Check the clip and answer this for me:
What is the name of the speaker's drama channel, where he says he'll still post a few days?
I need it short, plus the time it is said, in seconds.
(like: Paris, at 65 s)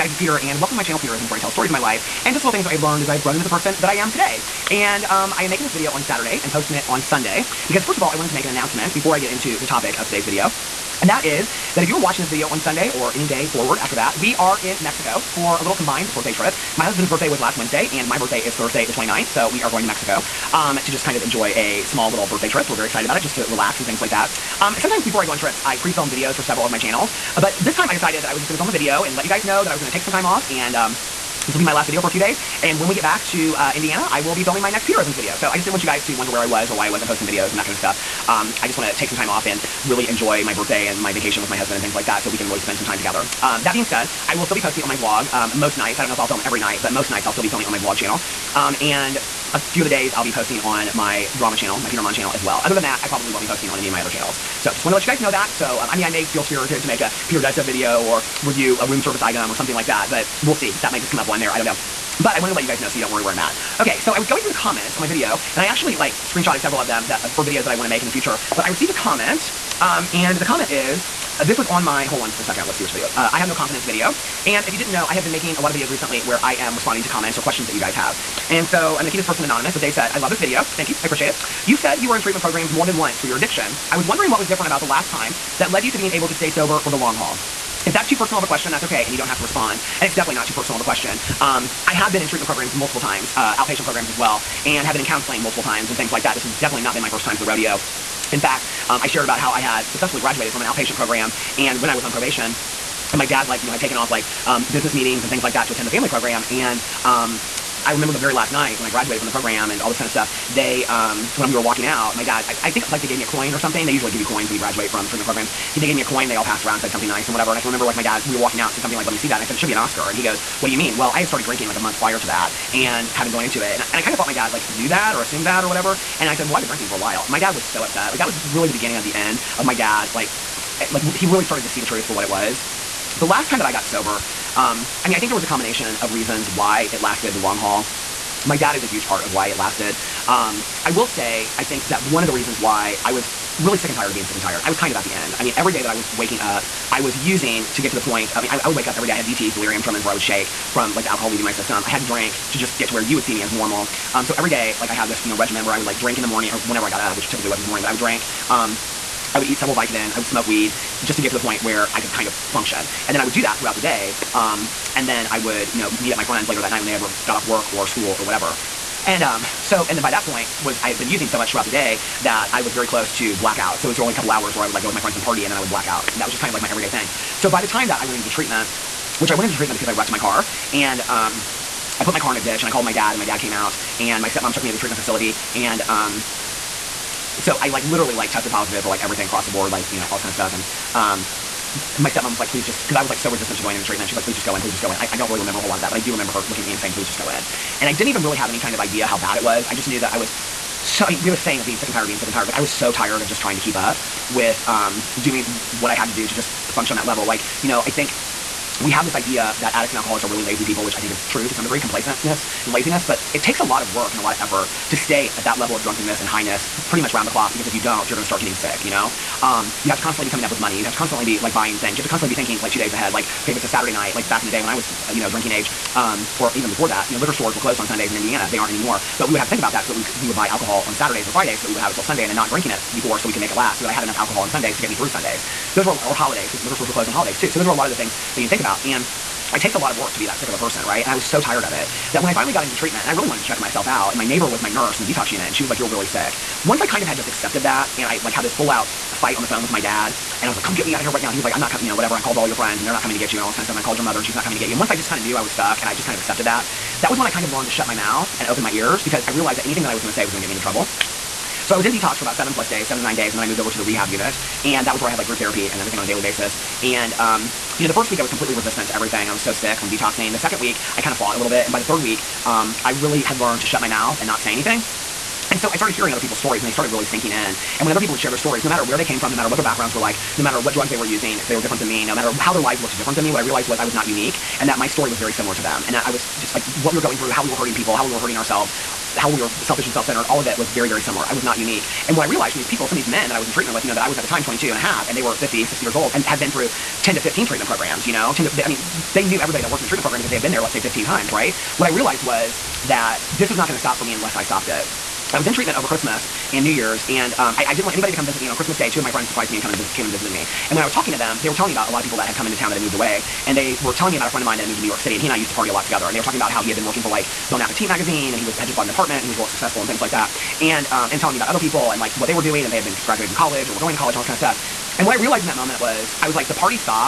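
Peter Monn, at 51 s.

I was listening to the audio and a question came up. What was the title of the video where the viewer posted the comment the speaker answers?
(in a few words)
I have no confidence.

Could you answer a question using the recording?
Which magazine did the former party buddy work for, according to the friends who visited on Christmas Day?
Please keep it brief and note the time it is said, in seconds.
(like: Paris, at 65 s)
Bon Appetit, at 317 s.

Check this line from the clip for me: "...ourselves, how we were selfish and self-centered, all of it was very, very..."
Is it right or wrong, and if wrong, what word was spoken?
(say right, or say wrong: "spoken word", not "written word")
right.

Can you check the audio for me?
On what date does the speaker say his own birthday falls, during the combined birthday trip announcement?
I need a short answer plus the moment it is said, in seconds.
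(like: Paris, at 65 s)
Thursday the 29th, at 18 s.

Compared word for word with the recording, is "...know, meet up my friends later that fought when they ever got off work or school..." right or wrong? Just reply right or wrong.
wrong.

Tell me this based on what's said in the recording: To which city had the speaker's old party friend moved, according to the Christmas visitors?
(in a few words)
New York City.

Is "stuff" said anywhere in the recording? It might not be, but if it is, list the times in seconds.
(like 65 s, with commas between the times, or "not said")
37 s, 57 s, 110 s, 190 s, 253 s, 324 s.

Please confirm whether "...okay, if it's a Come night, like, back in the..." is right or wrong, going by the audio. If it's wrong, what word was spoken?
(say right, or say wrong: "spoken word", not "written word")
wrong: "Saturday", not "Come".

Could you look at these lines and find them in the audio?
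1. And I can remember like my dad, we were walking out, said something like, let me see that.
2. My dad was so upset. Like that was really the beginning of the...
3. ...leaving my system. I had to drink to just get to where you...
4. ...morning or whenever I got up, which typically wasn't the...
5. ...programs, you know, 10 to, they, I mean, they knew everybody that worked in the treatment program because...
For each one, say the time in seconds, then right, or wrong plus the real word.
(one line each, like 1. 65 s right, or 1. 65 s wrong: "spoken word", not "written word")
1. 117 s right
2. 127 s right
3. 151 s right
4. 156 s right
5. 297 s right.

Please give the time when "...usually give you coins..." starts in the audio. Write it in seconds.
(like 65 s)
113 s.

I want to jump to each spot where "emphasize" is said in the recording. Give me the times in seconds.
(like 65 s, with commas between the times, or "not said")
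not said.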